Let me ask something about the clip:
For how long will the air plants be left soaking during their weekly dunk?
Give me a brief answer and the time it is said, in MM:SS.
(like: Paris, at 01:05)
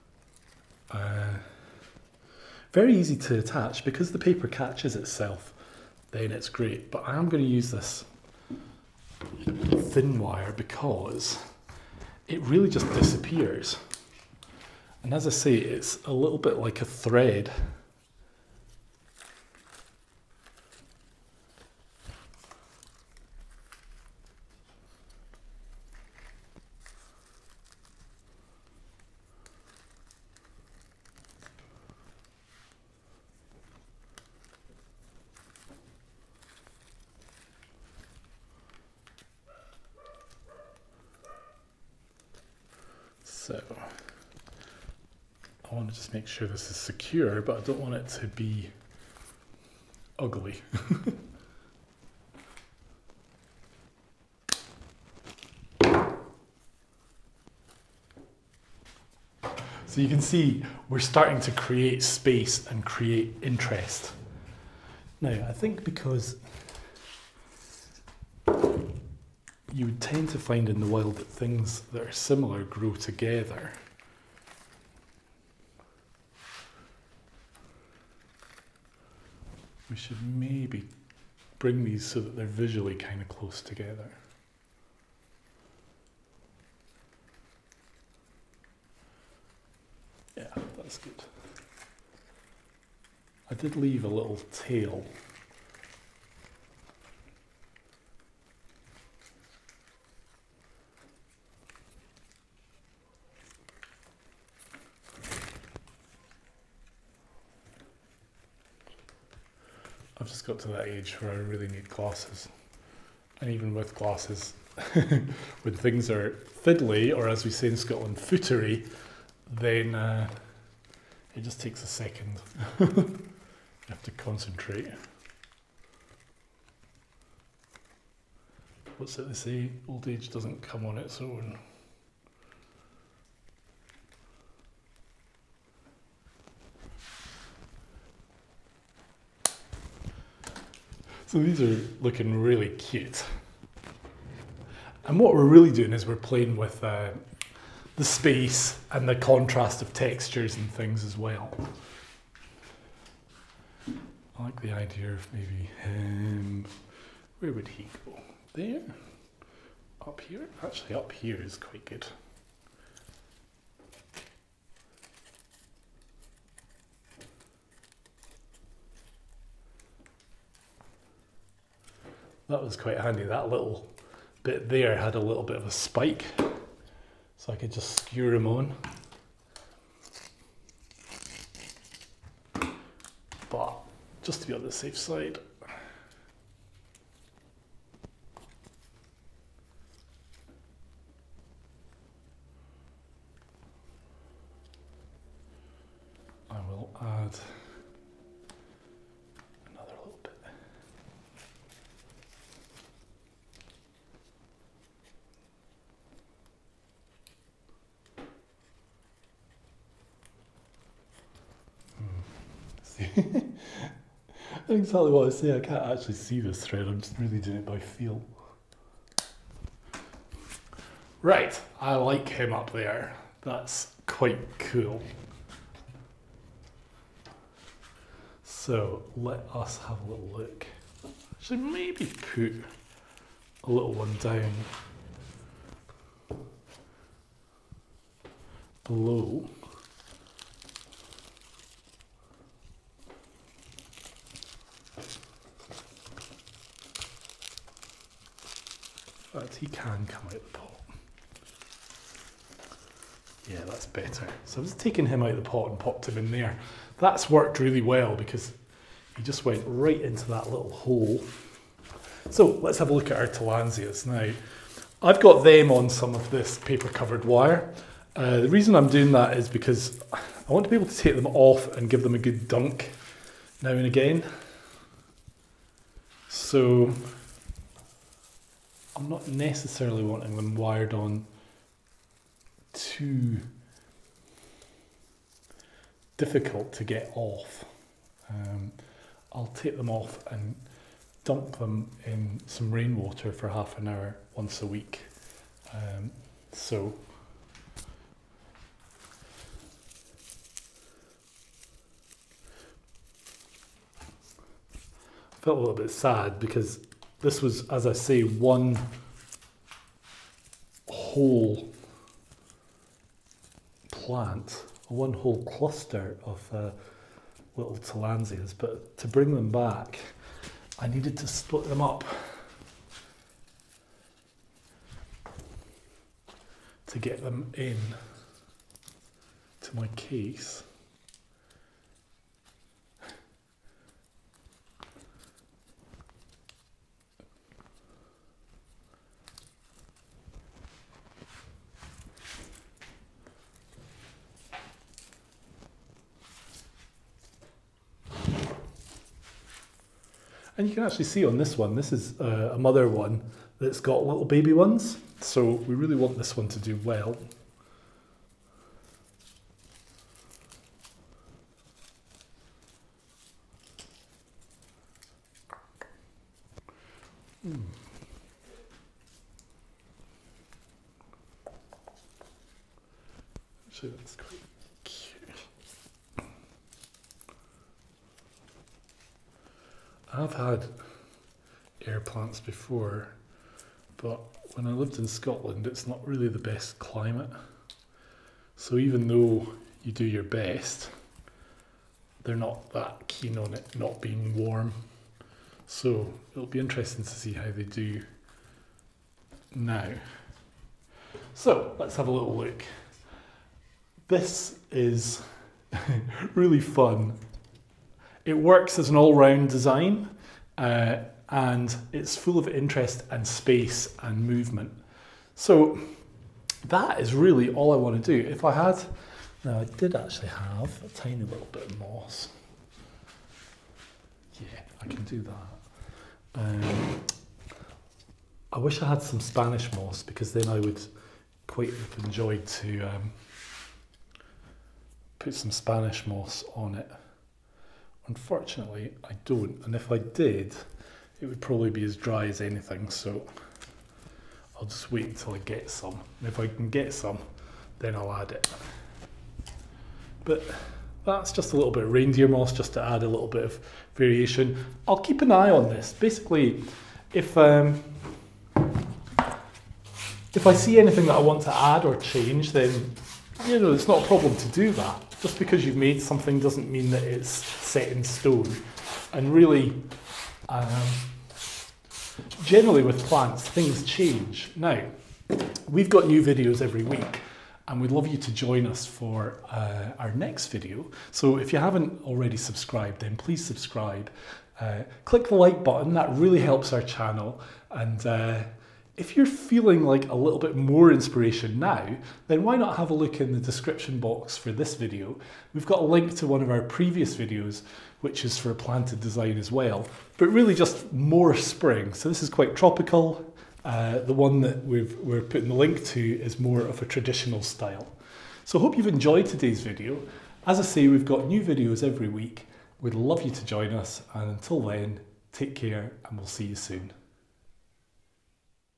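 half an hour, at 04:53.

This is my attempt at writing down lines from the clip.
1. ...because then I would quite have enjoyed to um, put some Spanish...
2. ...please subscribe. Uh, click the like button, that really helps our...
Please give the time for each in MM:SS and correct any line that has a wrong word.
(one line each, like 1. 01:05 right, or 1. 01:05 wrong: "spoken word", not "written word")
1. 07:10 right
2. 08:03 right.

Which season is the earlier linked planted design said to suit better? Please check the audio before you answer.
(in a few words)
spring.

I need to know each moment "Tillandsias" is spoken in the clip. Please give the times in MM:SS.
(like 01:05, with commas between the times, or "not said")
04:23, 05:17.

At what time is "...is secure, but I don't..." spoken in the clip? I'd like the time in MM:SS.
00:46.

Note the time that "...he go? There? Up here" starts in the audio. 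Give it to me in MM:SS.
02:37.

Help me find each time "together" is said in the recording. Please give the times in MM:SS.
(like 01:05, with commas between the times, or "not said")
01:12, 01:23.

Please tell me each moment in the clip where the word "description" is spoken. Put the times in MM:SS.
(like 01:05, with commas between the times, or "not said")
08:13.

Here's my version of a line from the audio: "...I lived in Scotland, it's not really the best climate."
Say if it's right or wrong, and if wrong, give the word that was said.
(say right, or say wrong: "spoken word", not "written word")
right.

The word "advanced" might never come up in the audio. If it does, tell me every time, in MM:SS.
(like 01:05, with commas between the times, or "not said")
not said.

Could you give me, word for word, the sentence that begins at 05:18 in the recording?
but to bring them back, I needed to split them up to get them in to my case.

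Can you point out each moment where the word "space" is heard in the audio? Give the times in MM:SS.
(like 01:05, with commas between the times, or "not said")
01:02, 02:28, 06:53.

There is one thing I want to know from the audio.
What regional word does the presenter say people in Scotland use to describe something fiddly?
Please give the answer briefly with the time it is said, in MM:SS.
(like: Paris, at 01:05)
footery, at 01:58.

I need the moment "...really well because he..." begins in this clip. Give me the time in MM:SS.
04:17.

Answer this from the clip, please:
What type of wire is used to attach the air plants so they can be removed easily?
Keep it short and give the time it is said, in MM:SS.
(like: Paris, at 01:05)
paper covered wire, at 04:26.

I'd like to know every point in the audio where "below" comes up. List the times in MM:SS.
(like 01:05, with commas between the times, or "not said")
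03:58.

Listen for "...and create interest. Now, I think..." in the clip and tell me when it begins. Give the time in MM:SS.
01:02.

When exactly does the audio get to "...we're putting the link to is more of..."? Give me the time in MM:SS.
08:24.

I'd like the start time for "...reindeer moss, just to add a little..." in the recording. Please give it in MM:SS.
07:31.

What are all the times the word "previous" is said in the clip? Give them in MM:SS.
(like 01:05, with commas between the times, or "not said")
08:16.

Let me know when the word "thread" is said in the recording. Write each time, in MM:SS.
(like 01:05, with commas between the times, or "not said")
00:16, 03:36.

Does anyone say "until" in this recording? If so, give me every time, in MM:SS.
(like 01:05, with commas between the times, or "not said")
07:25, 08:34.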